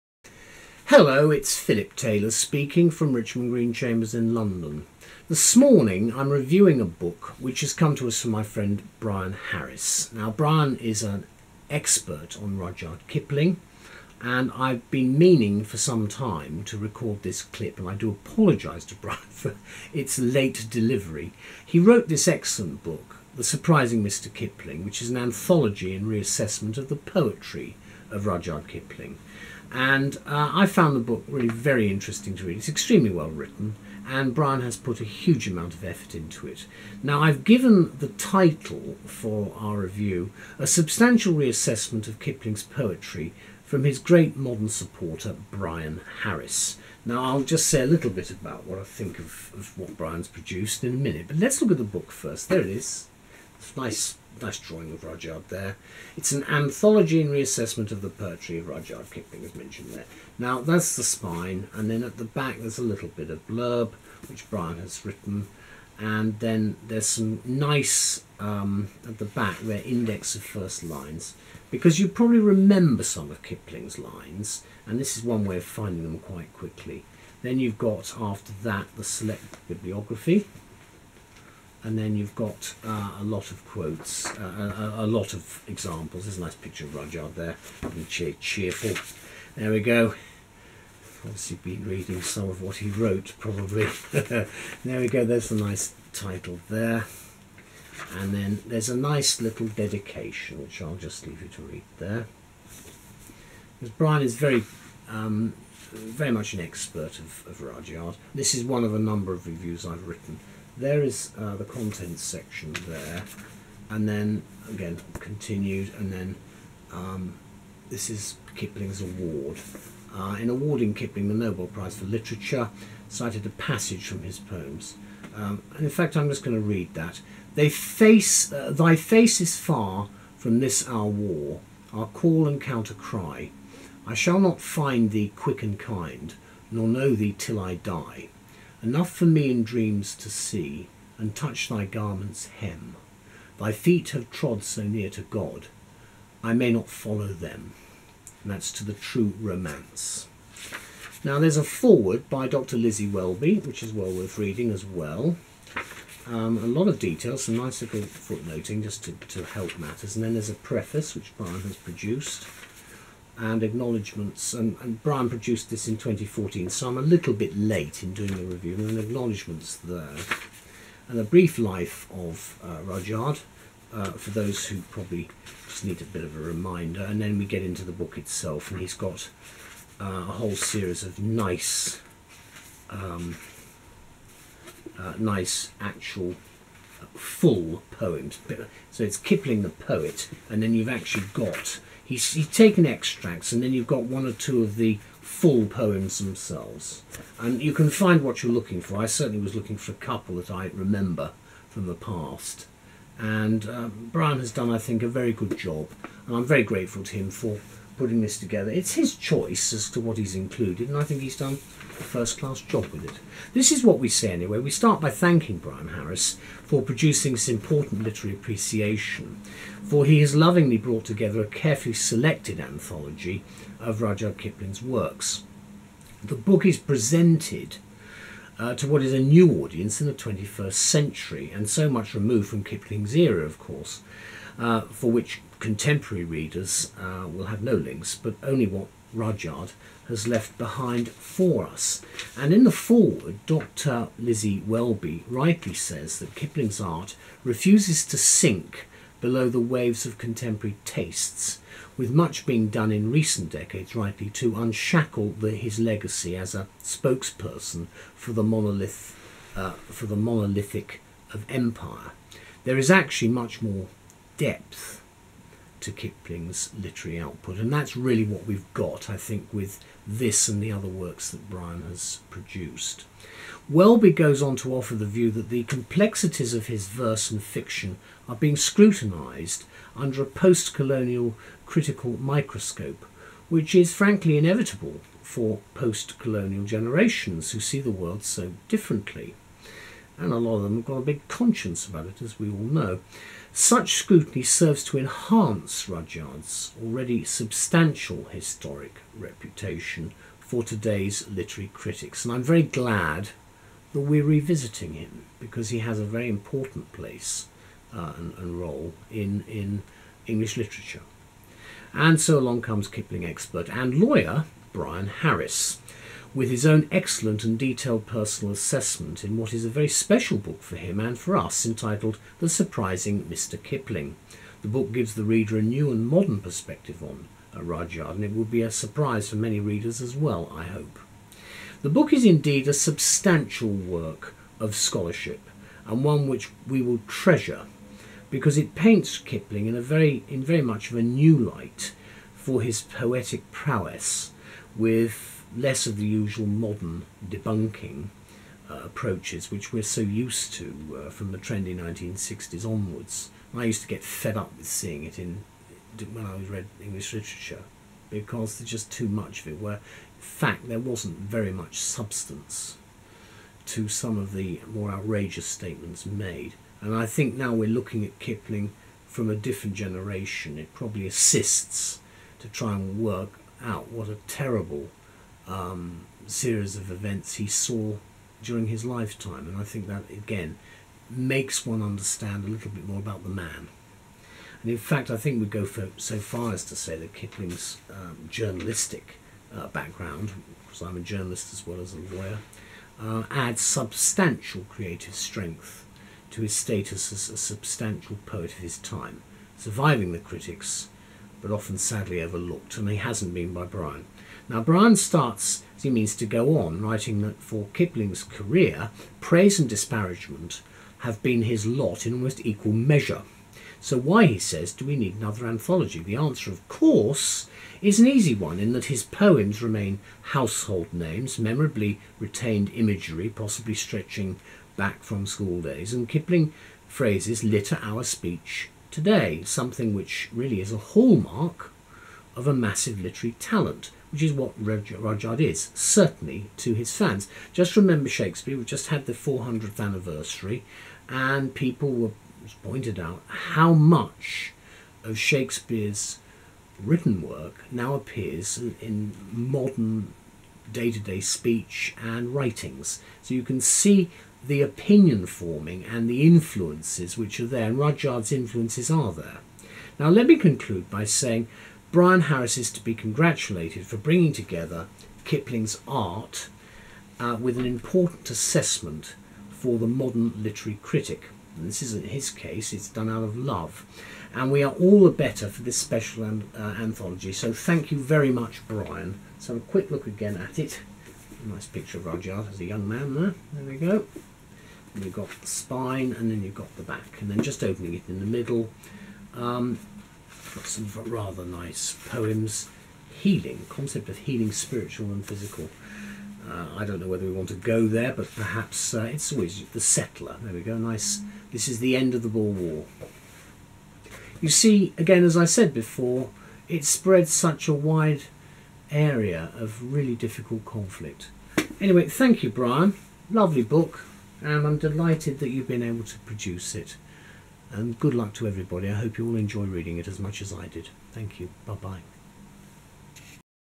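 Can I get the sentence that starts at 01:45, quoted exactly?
Um, very much an expert of, of Rudyard.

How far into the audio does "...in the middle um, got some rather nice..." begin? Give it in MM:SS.
08:08.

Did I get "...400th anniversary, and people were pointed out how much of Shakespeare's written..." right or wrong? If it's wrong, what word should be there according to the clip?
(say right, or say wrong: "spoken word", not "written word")
right.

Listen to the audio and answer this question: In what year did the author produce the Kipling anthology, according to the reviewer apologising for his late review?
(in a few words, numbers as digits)
2014.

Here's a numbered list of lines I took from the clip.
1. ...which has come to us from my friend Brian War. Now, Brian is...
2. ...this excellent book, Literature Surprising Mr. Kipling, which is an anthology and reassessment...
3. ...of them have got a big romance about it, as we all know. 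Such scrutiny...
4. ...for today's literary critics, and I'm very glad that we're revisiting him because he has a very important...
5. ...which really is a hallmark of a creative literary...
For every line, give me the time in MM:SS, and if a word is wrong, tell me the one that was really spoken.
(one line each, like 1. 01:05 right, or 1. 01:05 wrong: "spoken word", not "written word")
1. 00:07 wrong: "Harris", not "War"
2. 00:22 wrong: "The", not "Literature"
3. 04:50 wrong: "conscience", not "romance"
4. 05:00 right
5. 07:09 wrong: "massive", not "creative".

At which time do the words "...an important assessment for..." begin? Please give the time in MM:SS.
07:47.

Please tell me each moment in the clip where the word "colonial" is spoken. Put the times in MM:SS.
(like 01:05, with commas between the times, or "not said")
04:40, 04:46.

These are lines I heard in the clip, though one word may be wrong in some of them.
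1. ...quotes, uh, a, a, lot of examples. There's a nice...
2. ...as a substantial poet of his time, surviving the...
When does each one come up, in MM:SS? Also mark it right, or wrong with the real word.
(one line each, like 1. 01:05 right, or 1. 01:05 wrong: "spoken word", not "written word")
1. 01:23 right
2. 06:37 right.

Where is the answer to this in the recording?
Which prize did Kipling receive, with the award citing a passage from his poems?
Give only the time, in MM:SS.
02:01.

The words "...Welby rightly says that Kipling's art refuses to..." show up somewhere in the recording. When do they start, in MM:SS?
04:04.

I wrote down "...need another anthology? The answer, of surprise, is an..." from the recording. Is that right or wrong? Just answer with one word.
wrong.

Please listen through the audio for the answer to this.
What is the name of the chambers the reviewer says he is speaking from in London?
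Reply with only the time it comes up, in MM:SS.
00:03.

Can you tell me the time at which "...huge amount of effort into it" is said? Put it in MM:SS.
00:35.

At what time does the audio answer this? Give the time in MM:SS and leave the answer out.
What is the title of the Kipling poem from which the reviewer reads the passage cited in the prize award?
02:28.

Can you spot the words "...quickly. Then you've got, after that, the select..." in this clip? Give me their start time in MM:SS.
01:16.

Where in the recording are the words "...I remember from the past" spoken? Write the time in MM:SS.
03:20.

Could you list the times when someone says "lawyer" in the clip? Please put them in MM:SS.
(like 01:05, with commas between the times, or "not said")
05:13, 06:31.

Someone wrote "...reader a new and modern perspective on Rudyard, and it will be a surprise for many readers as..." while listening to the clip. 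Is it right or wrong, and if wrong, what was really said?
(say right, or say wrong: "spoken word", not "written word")
right.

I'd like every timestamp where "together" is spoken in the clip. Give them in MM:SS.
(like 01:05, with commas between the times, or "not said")
03:28, 03:41, 07:44.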